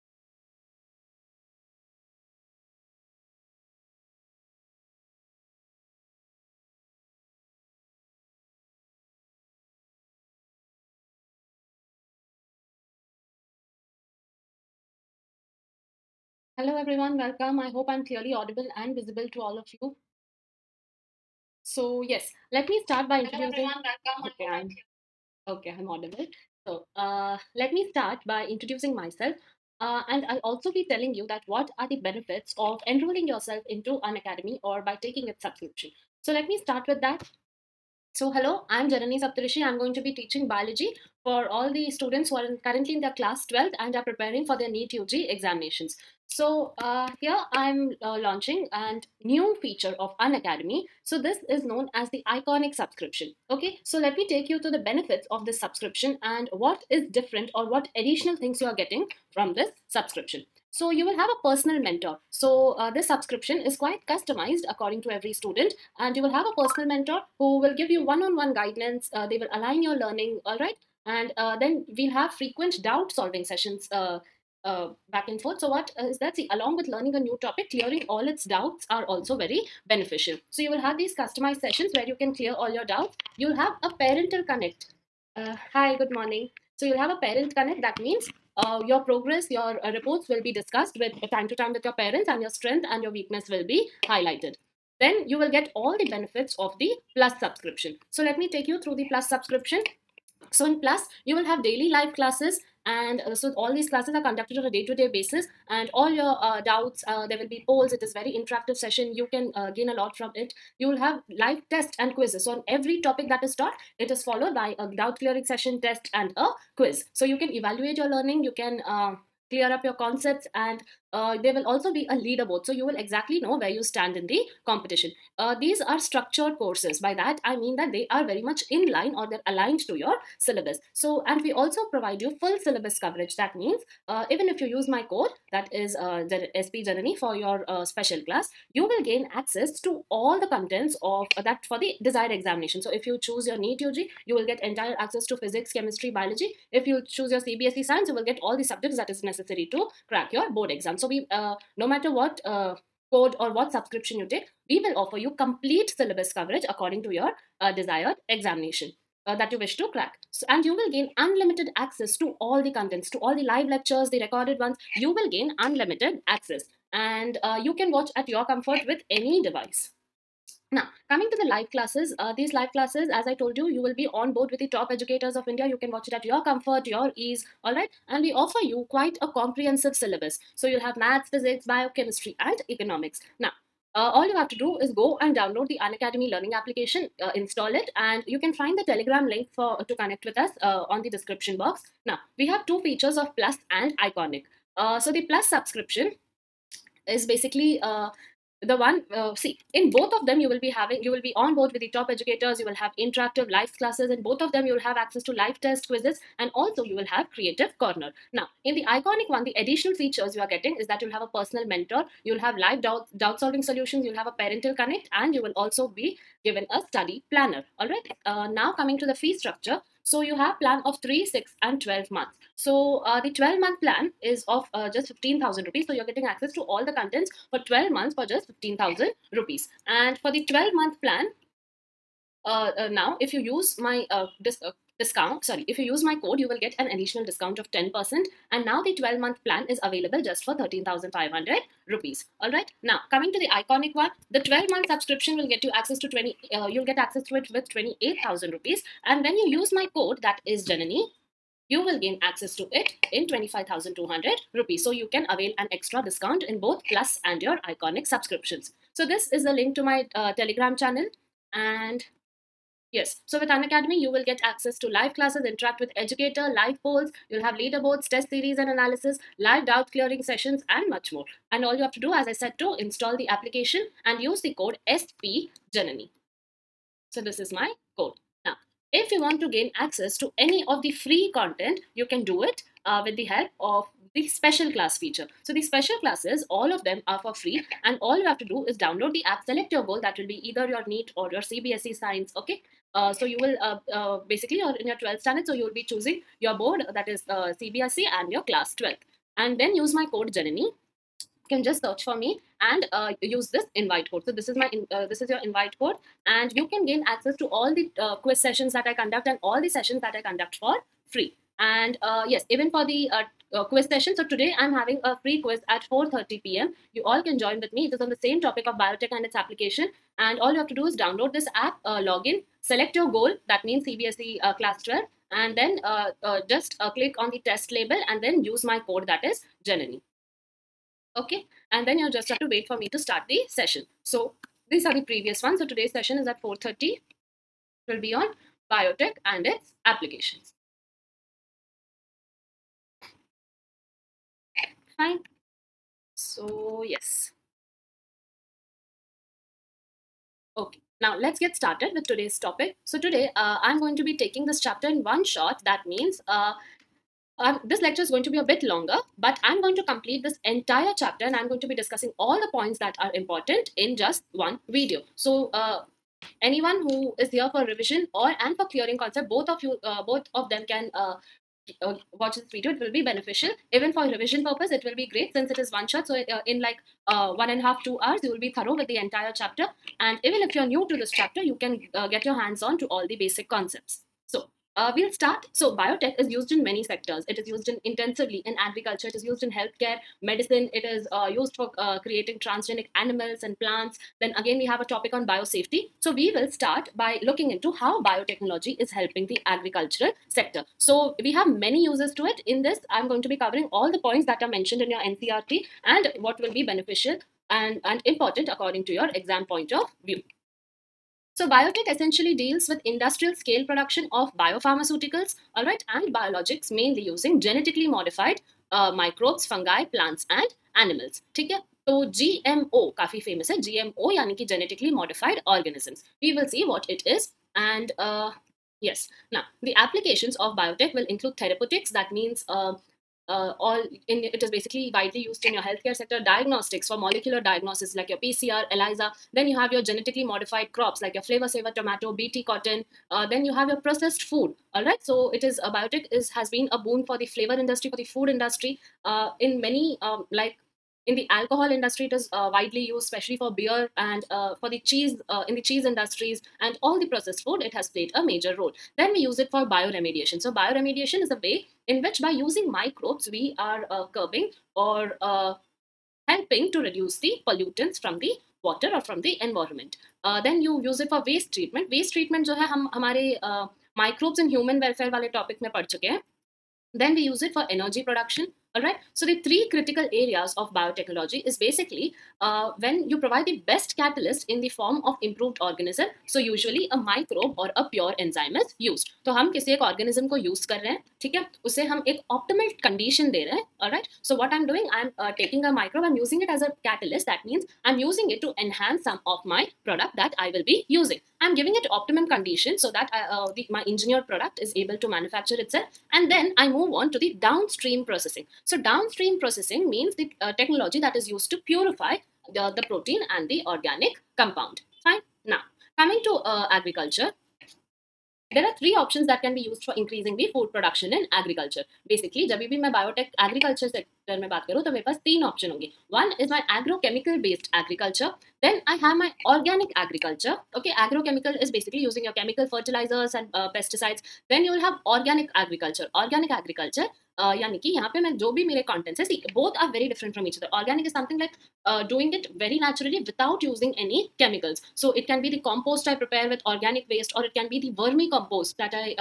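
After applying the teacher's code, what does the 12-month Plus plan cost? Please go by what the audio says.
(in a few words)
13,500 rupees.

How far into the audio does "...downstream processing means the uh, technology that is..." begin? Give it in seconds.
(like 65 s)
508 s.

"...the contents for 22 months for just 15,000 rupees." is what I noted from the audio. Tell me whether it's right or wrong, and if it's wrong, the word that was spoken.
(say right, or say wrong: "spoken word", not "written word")
wrong: "12", not "22".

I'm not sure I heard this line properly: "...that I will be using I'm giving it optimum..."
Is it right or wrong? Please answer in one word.
right.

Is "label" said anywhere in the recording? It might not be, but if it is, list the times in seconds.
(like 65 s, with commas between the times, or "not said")
327 s.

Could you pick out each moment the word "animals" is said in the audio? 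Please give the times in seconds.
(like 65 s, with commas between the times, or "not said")
392 s, 420 s.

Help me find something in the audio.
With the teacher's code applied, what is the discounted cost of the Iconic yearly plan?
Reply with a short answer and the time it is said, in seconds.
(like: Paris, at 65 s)
25,200 rupees, at 253 s.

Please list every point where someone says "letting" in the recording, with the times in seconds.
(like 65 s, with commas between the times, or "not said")
not said.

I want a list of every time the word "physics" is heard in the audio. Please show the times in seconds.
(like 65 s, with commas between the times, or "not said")
145 s, 181 s.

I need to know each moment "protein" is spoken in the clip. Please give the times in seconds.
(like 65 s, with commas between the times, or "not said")
512 s.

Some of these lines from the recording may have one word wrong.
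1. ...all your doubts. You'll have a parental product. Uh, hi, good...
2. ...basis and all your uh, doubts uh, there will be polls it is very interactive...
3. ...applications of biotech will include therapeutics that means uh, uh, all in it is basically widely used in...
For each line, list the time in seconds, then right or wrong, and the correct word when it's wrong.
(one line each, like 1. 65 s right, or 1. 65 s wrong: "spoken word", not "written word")
1. 82 s wrong: "connect", not "product"
2. 105 s right
3. 429 s right.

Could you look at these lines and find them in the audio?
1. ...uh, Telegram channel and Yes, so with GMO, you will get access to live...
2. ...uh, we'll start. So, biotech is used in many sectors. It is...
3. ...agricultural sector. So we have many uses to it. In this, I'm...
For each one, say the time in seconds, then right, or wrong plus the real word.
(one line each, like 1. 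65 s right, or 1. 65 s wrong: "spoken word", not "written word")
1. 260 s wrong: "Unacademy", not "GMO"
2. 384 s right
3. 399 s right.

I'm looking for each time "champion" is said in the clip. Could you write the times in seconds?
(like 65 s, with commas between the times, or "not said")
not said.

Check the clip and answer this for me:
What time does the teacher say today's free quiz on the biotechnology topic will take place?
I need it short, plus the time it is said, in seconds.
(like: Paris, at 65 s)
4:30 p.m., at 315 s.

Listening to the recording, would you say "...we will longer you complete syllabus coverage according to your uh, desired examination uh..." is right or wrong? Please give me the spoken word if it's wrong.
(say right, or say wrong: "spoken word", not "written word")
wrong: "offer", not "longer".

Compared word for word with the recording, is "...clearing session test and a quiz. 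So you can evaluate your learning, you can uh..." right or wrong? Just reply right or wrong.
right.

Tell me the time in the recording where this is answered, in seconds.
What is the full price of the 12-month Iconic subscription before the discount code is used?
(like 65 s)
247 s.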